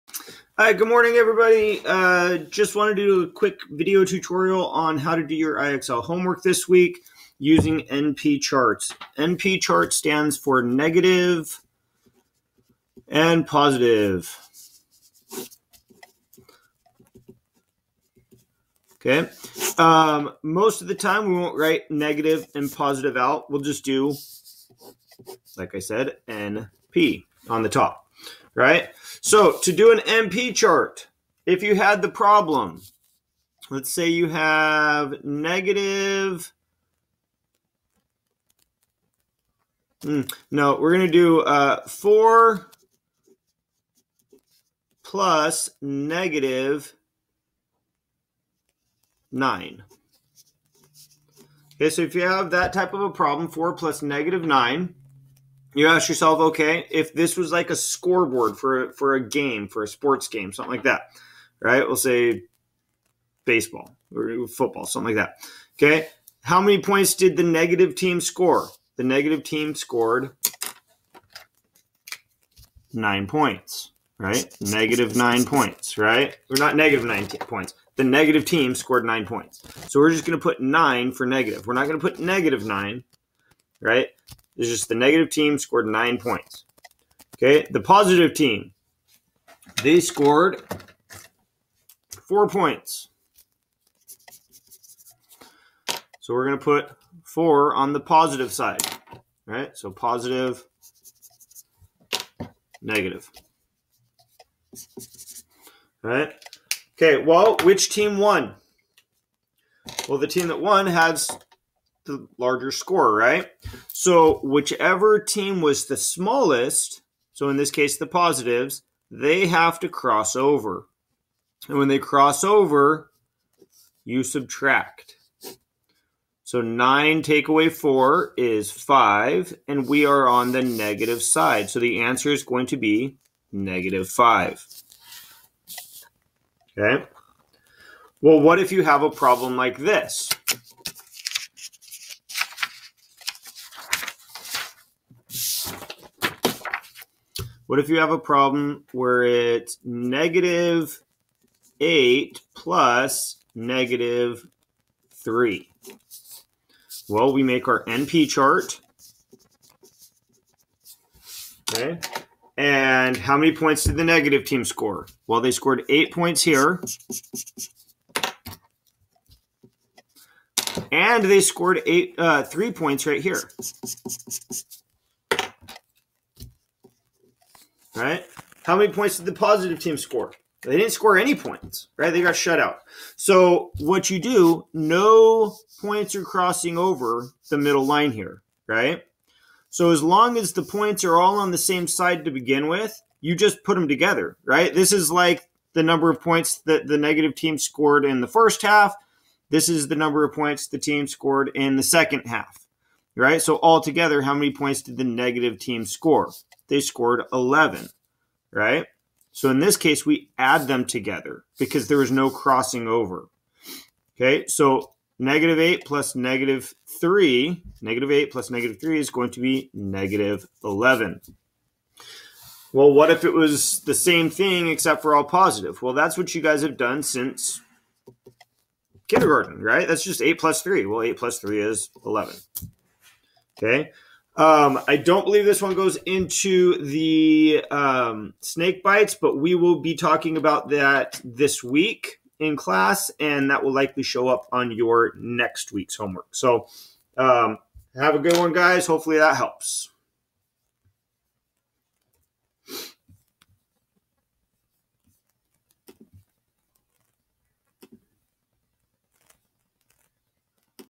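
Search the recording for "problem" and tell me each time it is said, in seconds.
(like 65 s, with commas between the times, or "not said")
32 s, 53 s, 139 s, 148 s.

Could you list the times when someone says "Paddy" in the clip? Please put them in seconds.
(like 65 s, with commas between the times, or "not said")
not said.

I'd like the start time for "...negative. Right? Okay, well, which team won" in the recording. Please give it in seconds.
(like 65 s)
102 s.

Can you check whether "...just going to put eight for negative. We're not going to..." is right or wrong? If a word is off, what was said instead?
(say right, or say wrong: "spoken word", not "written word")
wrong: "nine", not "eight".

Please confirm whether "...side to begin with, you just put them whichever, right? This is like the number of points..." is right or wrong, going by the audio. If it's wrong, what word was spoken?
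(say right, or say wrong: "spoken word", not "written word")
wrong: "together", not "whichever".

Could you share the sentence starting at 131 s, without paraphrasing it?
So the answer is going to be negative 5.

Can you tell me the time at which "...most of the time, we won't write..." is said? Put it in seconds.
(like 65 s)
20 s.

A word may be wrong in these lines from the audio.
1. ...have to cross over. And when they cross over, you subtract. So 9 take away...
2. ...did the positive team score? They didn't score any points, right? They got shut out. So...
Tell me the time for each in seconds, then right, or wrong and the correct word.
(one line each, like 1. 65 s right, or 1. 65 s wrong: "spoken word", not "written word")
1. 119 s right
2. 179 s right.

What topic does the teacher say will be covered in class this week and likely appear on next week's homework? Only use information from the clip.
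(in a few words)
snake bites.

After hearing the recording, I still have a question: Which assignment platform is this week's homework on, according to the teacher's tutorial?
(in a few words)
IXL.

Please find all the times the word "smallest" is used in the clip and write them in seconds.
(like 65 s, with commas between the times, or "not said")
115 s.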